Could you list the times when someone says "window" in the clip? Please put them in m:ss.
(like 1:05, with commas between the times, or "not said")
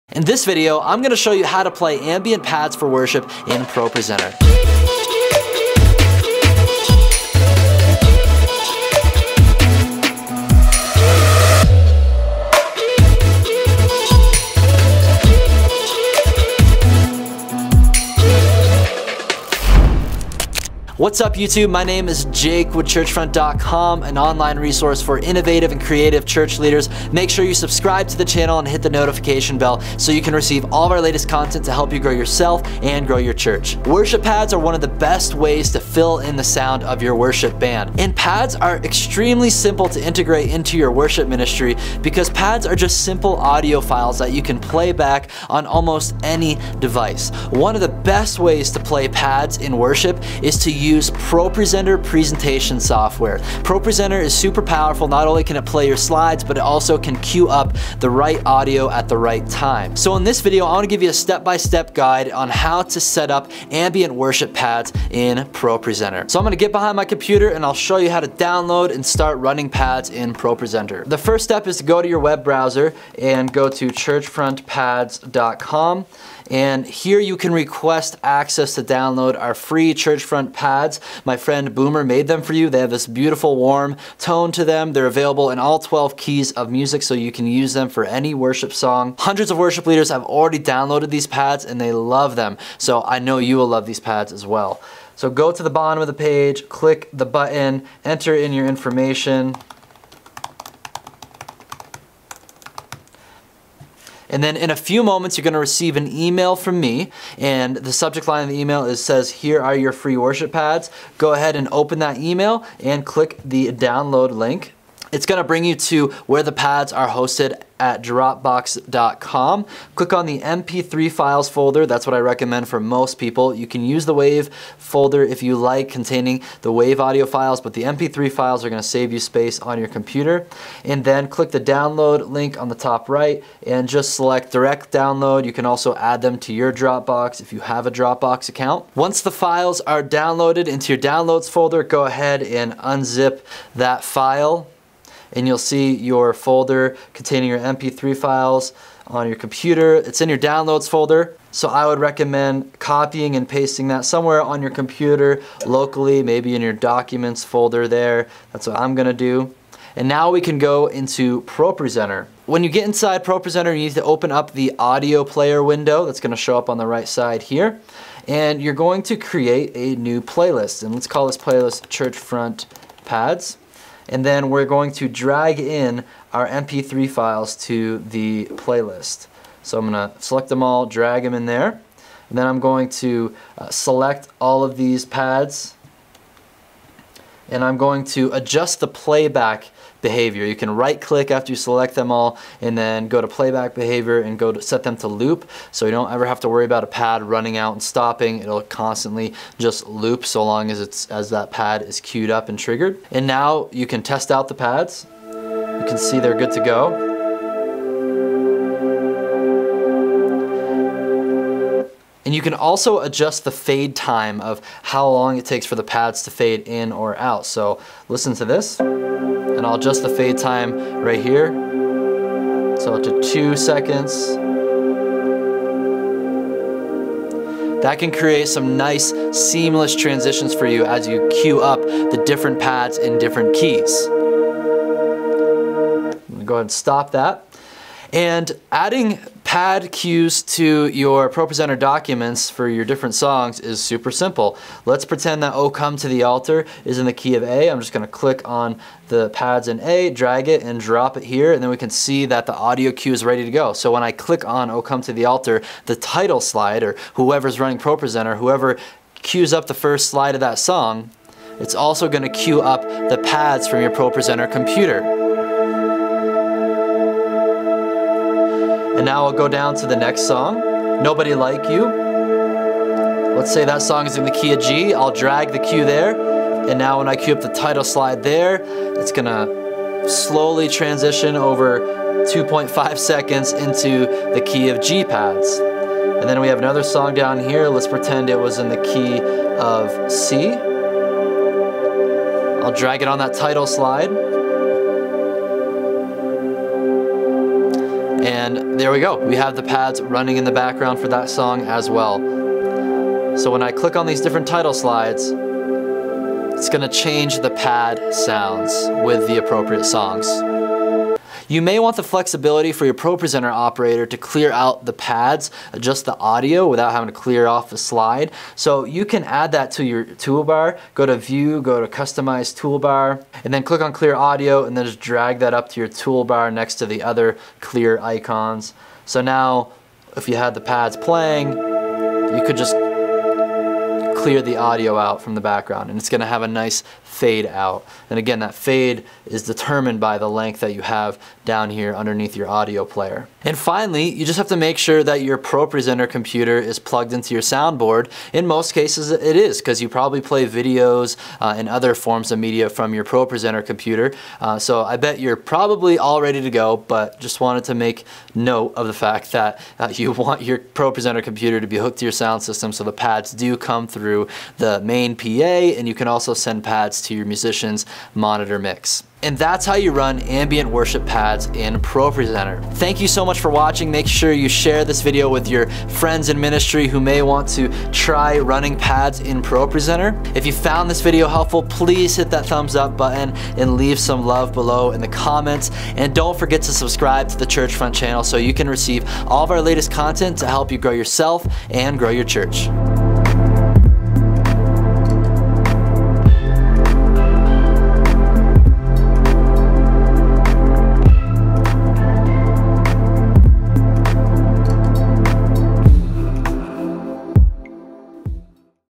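2:45.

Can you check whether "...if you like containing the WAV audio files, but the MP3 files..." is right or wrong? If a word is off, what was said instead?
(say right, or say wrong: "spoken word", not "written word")
right.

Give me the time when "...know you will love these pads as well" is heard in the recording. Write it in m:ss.
1:33.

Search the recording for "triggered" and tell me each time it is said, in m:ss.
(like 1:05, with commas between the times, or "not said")
3:22.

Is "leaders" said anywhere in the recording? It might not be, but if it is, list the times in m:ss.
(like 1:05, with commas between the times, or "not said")
0:26, 1:29.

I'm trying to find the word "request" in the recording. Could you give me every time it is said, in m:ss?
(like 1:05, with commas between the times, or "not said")
1:17.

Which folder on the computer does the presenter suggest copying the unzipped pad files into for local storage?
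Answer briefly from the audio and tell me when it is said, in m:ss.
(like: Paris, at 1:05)
documents folder, at 2:36.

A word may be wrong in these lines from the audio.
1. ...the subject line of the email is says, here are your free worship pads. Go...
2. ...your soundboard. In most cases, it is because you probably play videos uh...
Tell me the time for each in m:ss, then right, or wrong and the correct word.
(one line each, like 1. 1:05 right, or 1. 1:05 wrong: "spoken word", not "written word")
1. 1:47 right
2. 5:47 right.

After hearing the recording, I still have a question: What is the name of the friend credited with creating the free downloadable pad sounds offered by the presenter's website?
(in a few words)
Boomer.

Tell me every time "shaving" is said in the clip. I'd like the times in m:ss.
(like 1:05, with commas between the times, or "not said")
not said.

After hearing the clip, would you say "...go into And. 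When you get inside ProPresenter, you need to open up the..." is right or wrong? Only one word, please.
wrong.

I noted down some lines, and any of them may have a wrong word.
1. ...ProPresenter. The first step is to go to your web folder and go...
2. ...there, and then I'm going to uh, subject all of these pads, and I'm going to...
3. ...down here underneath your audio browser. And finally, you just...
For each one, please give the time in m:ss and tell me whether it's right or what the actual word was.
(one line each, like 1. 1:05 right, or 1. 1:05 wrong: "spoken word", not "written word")
1. 1:10 wrong: "browser", not "folder"
2. 3:01 wrong: "select", not "subject"
3. 5:41 wrong: "player", not "browser".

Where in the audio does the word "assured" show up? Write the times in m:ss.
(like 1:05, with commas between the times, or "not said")
not said.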